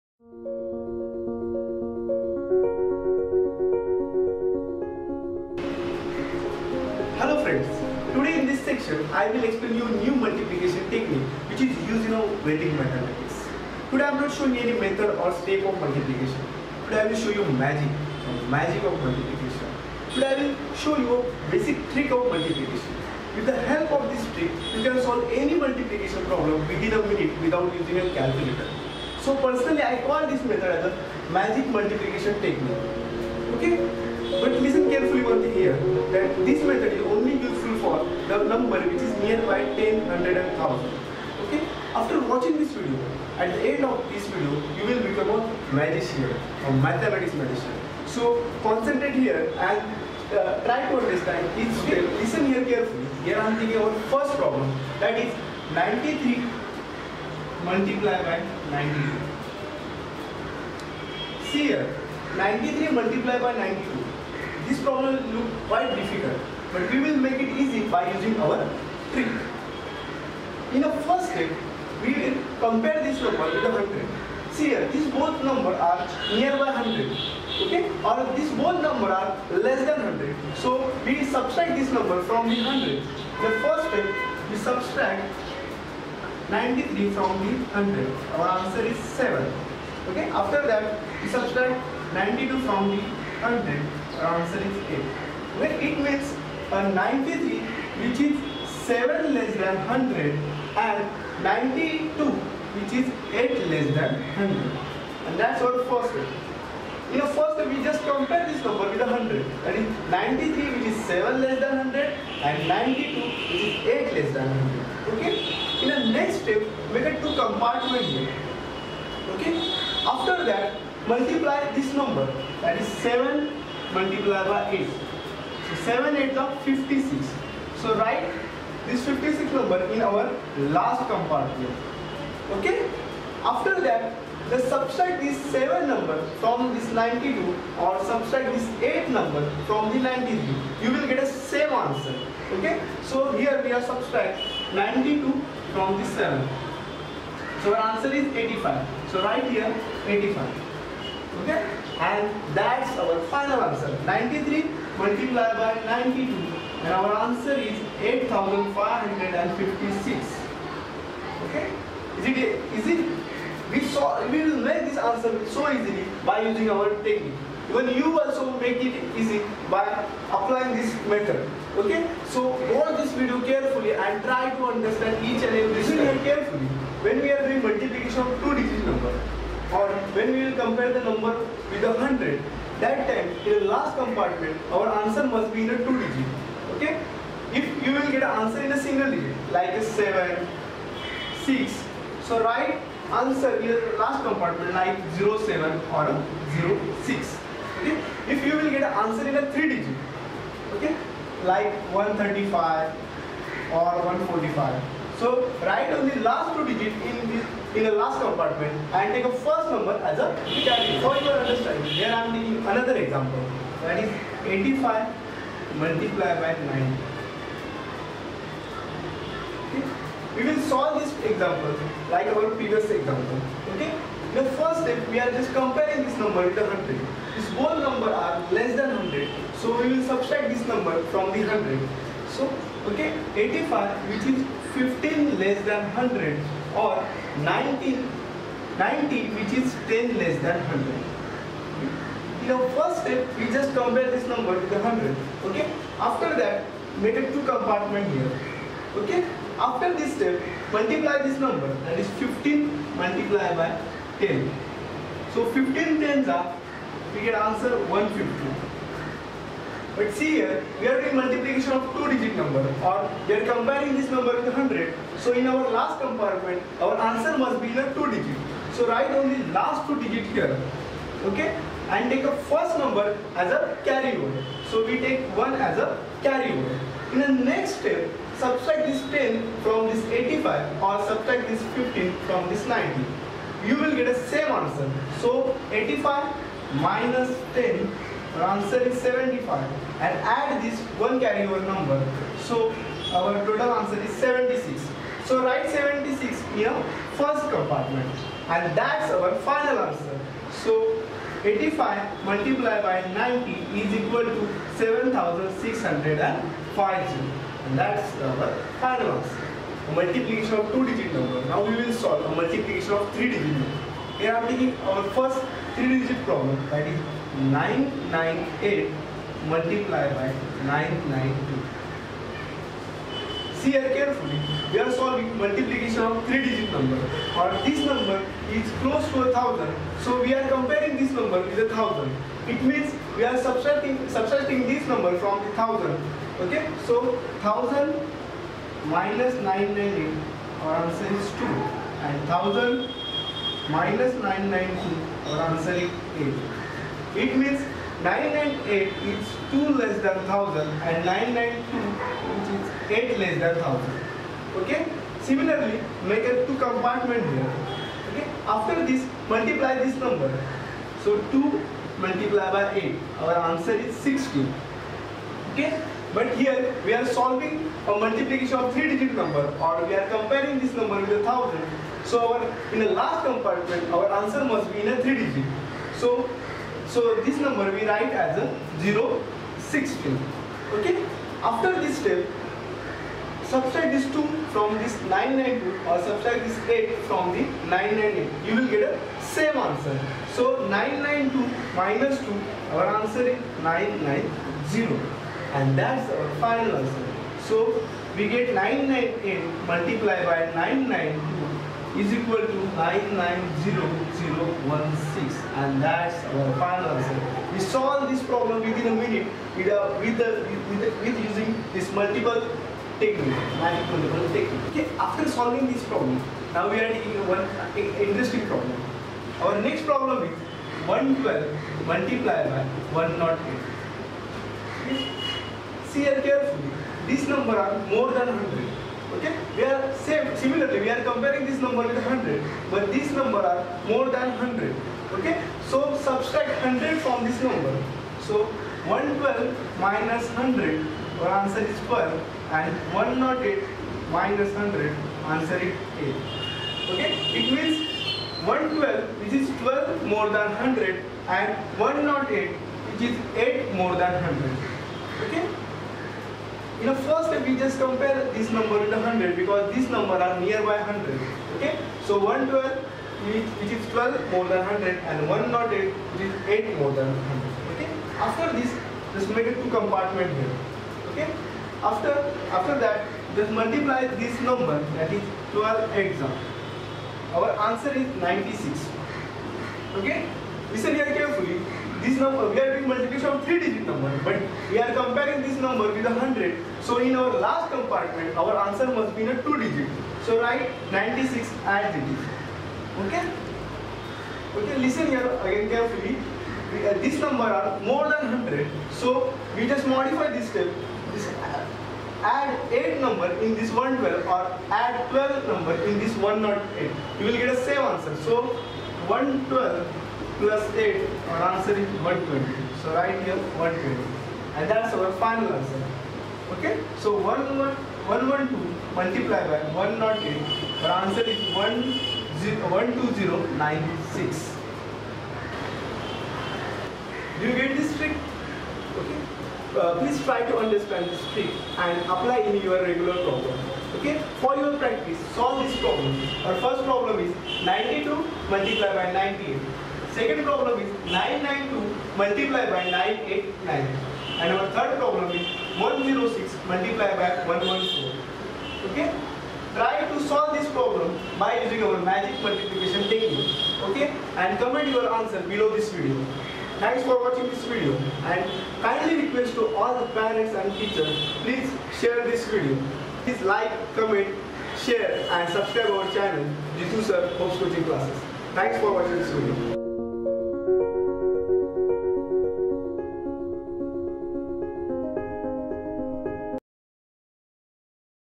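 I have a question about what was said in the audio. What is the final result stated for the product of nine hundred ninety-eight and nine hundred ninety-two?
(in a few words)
990016.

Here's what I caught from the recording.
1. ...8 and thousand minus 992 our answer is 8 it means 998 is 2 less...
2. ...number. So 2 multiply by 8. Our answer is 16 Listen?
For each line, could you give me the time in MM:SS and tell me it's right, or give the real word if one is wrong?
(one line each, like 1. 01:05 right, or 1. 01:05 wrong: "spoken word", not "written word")
1. 05:41 wrong: "2", not "8"
2. 05:59 wrong: "Okay", not "Listen".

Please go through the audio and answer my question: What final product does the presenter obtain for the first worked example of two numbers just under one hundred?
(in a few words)
8556.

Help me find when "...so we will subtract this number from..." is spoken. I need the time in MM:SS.
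03:49.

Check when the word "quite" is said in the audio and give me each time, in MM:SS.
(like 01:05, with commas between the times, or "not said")
01:05.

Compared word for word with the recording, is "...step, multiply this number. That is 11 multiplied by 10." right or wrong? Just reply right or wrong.
wrong.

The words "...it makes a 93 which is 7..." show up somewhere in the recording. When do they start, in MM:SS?
01:35.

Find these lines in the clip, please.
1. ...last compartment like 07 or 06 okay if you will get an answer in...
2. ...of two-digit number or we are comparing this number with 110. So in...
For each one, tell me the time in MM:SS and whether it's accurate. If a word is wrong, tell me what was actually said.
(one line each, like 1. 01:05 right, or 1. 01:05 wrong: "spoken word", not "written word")
1. 03:14 right
2. 04:21 wrong: "100", not "110".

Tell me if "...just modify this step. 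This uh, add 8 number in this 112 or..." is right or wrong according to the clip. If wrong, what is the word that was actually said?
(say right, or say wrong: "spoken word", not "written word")
right.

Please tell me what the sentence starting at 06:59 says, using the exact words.
Our next problem is 112 multiplied by 108.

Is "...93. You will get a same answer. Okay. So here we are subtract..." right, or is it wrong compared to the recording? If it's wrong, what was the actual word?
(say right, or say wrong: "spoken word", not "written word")
right.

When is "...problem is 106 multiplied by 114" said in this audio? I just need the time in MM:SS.
09:04.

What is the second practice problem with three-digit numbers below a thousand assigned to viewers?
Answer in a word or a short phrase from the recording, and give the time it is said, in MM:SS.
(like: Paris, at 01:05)
992 × 989, at 09:01.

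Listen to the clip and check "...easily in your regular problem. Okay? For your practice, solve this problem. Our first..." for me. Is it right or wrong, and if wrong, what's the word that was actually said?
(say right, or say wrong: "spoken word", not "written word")
wrong: "apply", not "easily".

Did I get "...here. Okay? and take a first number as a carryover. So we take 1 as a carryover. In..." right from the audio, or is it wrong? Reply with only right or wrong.
right.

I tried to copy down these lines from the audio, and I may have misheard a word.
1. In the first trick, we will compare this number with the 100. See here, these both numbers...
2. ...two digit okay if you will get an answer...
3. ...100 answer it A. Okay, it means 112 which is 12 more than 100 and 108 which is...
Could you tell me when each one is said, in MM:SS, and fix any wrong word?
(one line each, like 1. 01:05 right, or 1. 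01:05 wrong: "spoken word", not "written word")
1. 01:10 right
2. 03:05 right
3. 07:24 right.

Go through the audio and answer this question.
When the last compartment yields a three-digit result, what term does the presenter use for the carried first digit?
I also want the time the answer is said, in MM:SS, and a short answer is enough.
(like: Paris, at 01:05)
return, at 03:30.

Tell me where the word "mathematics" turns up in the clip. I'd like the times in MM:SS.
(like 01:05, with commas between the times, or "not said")
00:12, 00:46.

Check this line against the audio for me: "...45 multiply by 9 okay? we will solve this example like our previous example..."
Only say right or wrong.
wrong.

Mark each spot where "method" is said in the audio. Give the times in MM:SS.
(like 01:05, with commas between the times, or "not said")
00:14, 00:30, 00:36, 02:51.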